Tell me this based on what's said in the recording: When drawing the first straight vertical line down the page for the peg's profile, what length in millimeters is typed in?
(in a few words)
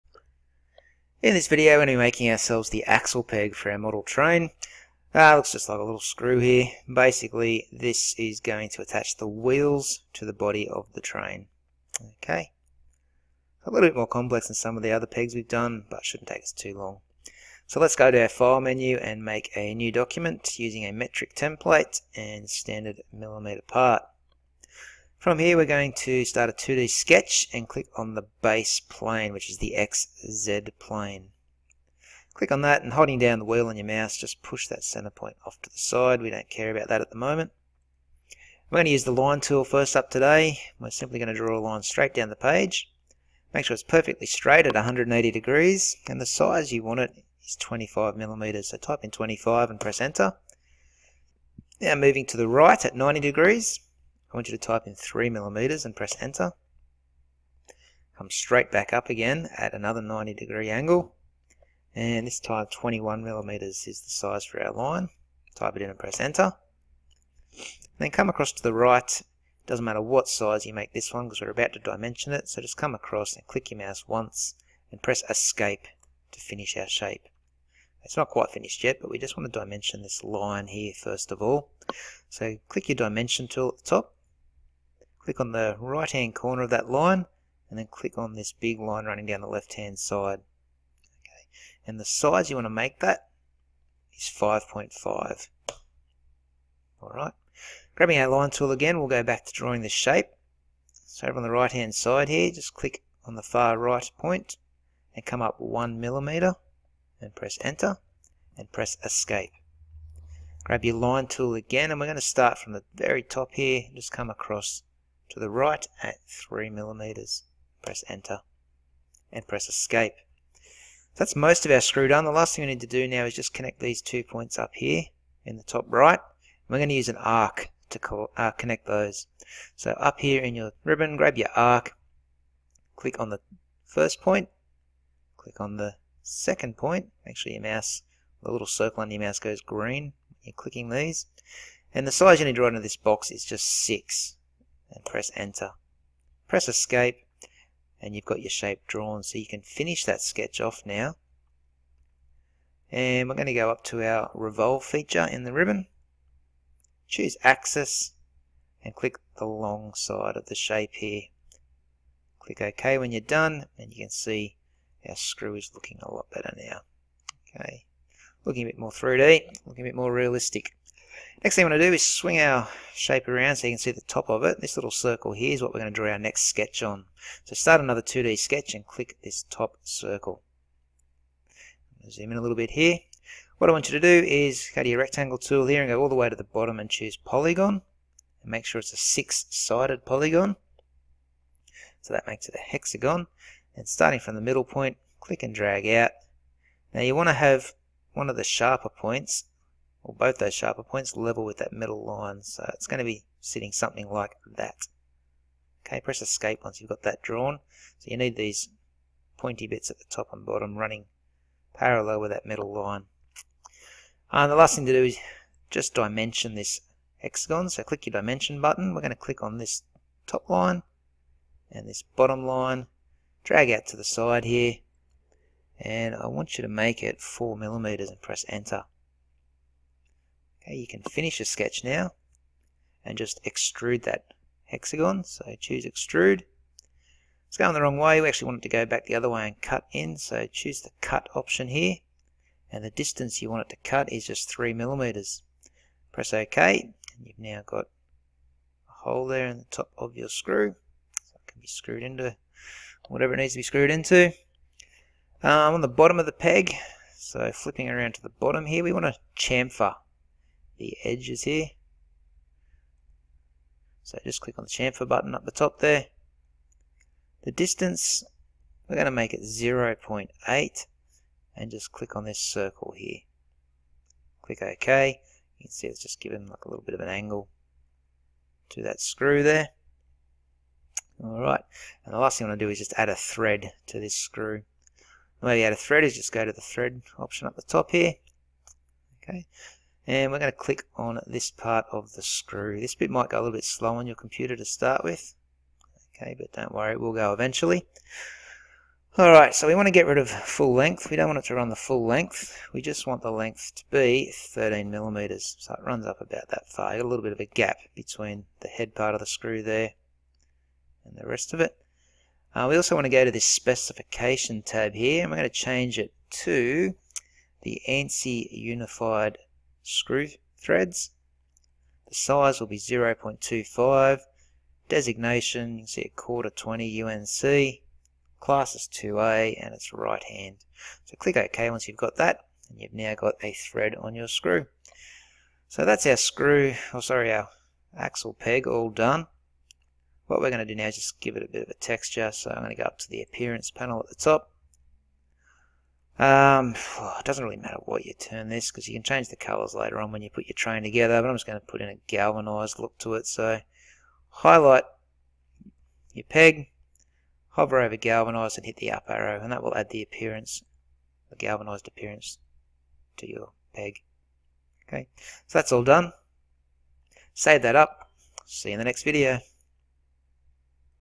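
25.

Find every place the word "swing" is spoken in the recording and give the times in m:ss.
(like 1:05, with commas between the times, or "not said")
2:52.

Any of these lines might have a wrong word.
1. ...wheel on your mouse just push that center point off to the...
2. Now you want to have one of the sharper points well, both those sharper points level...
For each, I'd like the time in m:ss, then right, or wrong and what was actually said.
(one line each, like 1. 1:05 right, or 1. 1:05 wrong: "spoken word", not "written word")
1. 0:33 right
2. 3:16 right.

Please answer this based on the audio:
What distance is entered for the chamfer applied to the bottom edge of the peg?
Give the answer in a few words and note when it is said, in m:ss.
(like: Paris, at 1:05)
0.8, at 4:29.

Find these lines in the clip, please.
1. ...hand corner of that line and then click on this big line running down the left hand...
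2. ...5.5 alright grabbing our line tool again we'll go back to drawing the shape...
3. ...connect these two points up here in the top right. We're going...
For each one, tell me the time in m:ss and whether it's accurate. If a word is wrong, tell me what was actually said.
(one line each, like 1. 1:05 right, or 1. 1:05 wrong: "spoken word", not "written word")
1. 1:26 right
2. 1:34 right
3. 2:03 right.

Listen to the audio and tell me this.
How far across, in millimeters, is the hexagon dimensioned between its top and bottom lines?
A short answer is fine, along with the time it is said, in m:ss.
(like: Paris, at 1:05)
4 millimeters, at 3:47.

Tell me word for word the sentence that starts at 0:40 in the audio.
We're simply going to draw a line straight down the page.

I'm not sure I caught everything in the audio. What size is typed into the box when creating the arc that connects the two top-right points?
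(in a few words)
6.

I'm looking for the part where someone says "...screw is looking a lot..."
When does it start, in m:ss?
2:45.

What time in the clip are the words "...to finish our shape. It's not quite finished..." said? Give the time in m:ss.
1:16.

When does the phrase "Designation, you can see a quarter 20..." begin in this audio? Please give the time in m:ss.
5:24.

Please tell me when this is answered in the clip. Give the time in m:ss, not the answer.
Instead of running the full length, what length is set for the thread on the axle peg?
5:04.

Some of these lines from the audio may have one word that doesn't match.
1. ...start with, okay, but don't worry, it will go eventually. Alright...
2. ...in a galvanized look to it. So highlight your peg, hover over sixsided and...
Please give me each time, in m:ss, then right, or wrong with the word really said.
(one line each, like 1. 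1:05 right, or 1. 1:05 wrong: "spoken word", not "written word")
1. 4:54 right
2. 5:51 wrong: "galvanized", not "sixsided".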